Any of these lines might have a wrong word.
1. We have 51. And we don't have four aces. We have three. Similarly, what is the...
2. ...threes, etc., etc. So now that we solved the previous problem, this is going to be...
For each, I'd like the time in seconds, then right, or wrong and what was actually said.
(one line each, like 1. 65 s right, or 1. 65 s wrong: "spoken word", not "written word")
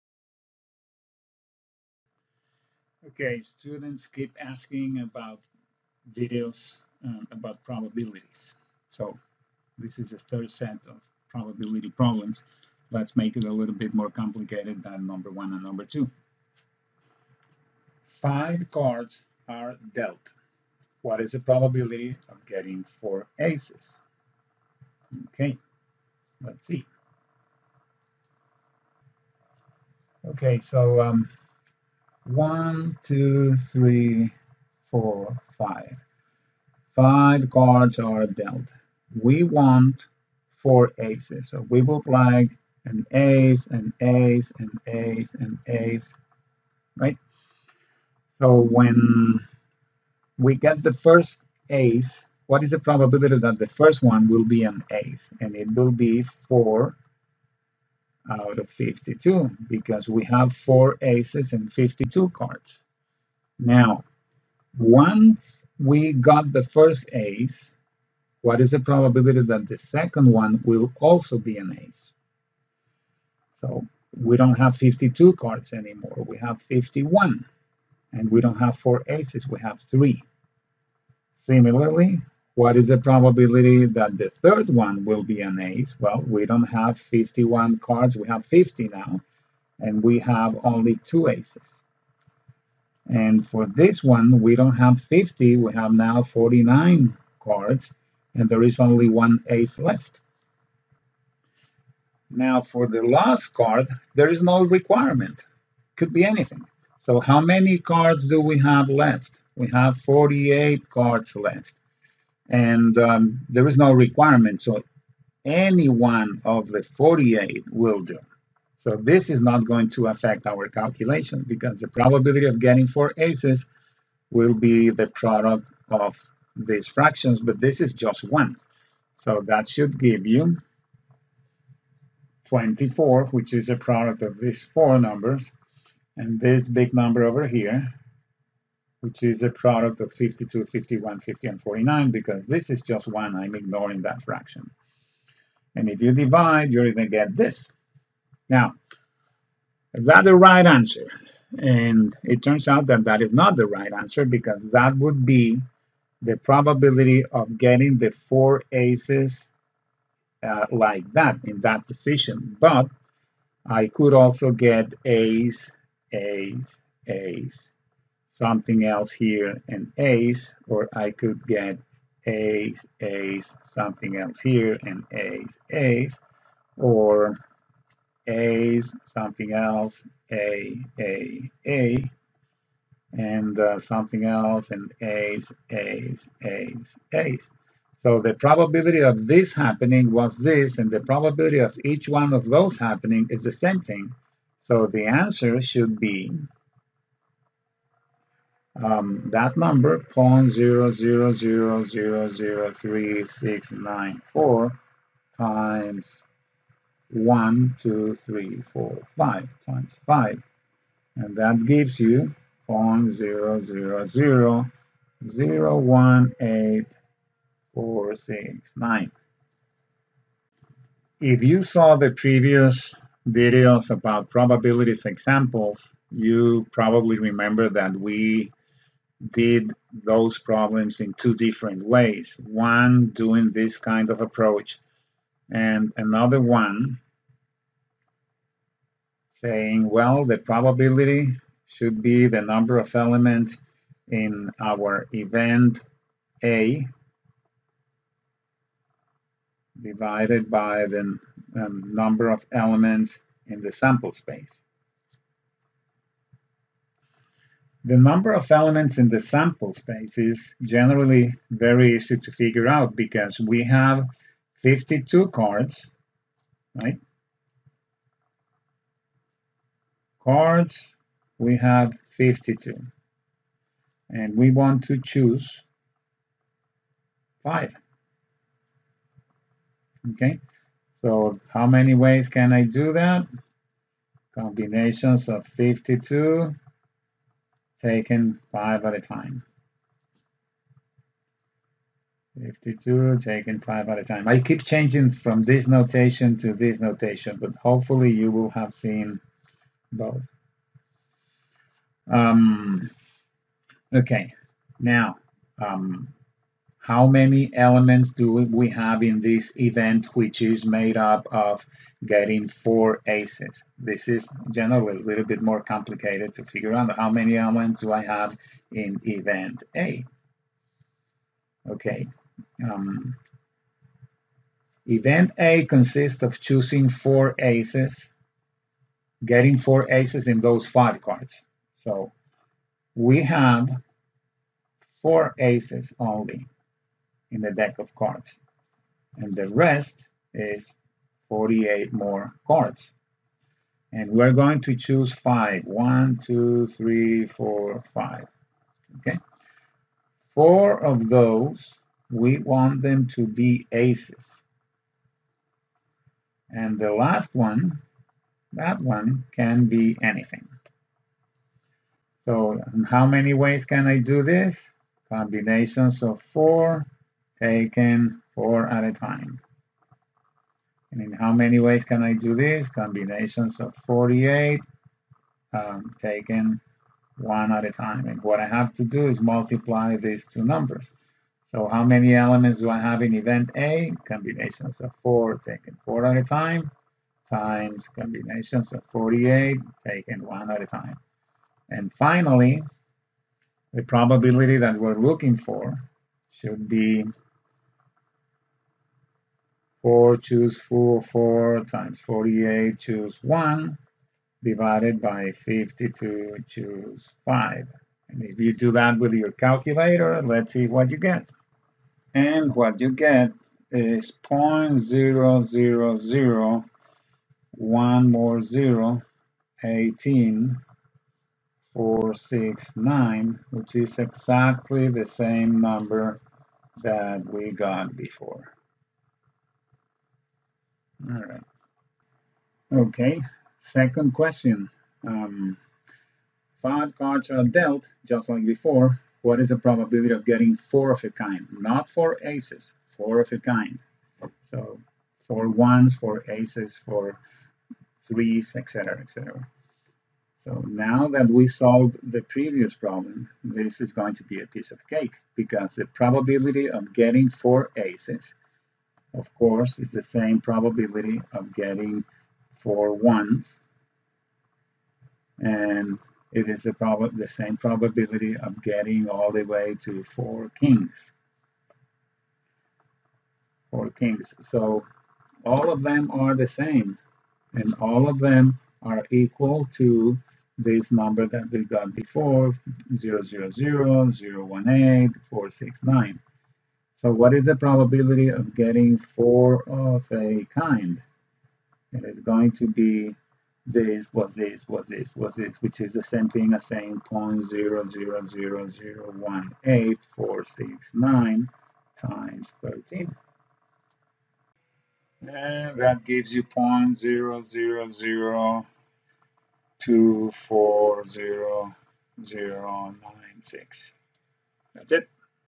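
1. 76 s right
2. 448 s right.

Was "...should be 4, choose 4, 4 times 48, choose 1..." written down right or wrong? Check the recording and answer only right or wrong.
right.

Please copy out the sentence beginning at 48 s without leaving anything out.
So when we get the first ace, what is the probability that the first one will be an ace?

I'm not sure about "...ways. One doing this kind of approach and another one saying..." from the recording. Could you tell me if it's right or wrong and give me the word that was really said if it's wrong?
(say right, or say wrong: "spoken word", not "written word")
right.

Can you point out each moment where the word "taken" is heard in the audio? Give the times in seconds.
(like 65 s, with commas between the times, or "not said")
287 s, 293 s, 367 s, 375 s, 385 s, 389 s.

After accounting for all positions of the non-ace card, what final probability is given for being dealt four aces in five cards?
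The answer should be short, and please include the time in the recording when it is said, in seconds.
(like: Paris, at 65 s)
0.00018469, at 212 s.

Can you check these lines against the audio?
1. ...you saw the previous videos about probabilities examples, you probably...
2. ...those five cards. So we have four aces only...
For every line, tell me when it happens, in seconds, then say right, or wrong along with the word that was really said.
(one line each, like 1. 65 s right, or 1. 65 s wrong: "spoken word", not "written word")
1. 221 s right
2. 330 s right.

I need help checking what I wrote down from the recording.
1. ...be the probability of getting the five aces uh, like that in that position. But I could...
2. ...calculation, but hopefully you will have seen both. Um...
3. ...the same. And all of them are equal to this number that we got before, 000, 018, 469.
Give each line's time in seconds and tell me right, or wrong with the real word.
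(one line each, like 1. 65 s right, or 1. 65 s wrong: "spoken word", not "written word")
1. 155 s wrong: "four", not "five"
2. 296 s wrong: "notation", not "calculation"
3. 476 s right.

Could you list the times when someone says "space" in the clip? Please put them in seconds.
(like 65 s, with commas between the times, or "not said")
254 s, 259 s.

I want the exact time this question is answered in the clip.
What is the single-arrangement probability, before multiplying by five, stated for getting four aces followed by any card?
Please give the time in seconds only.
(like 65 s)
199 s.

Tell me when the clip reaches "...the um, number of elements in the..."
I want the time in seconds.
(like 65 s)
250 s.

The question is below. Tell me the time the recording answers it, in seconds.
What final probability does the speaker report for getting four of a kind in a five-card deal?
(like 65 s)
506 s.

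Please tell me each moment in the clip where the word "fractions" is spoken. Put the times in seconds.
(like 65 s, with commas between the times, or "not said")
126 s, 144 s.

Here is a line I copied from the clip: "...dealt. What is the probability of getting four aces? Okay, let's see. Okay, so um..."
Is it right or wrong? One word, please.
right.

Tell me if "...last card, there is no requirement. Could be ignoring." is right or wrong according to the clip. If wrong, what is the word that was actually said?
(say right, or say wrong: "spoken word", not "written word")
wrong: "anything", not "ignoring".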